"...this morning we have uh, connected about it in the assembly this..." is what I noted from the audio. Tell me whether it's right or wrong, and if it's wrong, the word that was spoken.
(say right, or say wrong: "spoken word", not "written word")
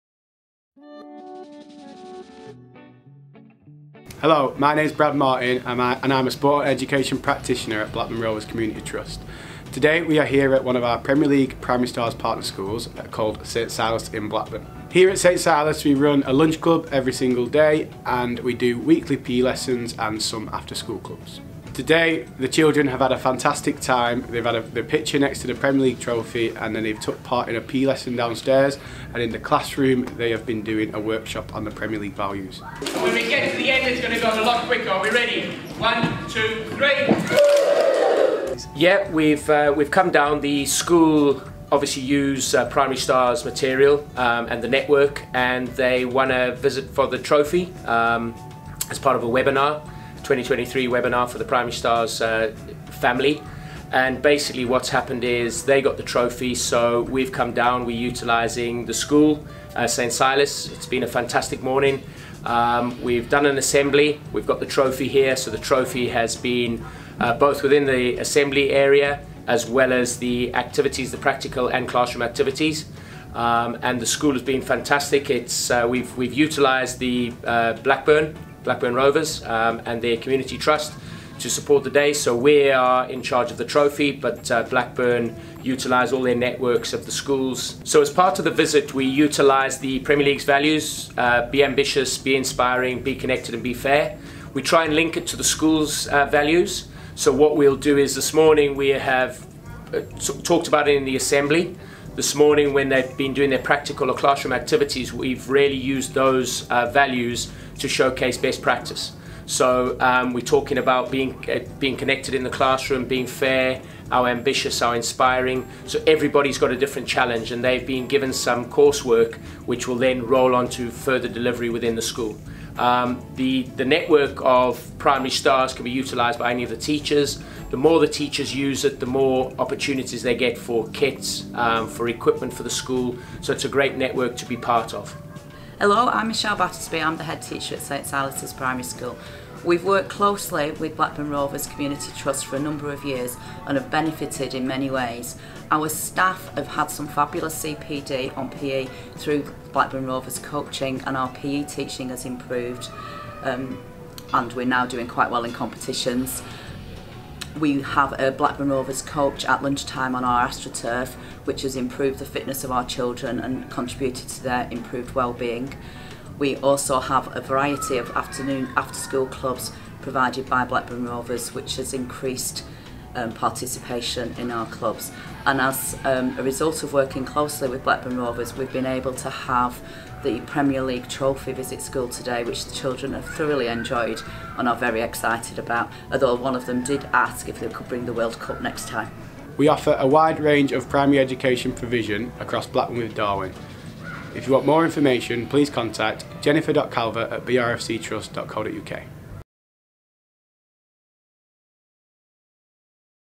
wrong: "talked", not "connected".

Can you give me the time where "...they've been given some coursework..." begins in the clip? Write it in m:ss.
1:57.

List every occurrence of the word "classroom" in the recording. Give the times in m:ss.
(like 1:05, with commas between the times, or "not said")
0:29, 1:11, 1:44, 1:52.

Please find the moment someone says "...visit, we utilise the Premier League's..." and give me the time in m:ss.
1:28.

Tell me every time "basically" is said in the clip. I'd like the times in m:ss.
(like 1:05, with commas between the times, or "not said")
0:54.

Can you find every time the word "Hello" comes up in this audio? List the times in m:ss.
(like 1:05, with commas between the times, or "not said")
0:04, 2:15.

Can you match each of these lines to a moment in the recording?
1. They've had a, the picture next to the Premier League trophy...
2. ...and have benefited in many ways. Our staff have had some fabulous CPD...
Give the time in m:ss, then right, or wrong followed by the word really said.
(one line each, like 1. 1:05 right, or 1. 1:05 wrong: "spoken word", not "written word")
1. 0:24 right
2. 2:23 right.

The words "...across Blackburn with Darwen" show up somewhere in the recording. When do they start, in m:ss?
3:12.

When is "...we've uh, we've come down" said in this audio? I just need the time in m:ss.
0:39.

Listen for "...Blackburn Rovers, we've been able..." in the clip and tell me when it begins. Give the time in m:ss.
2:57.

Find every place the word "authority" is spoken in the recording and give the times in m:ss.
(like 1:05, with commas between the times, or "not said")
not said.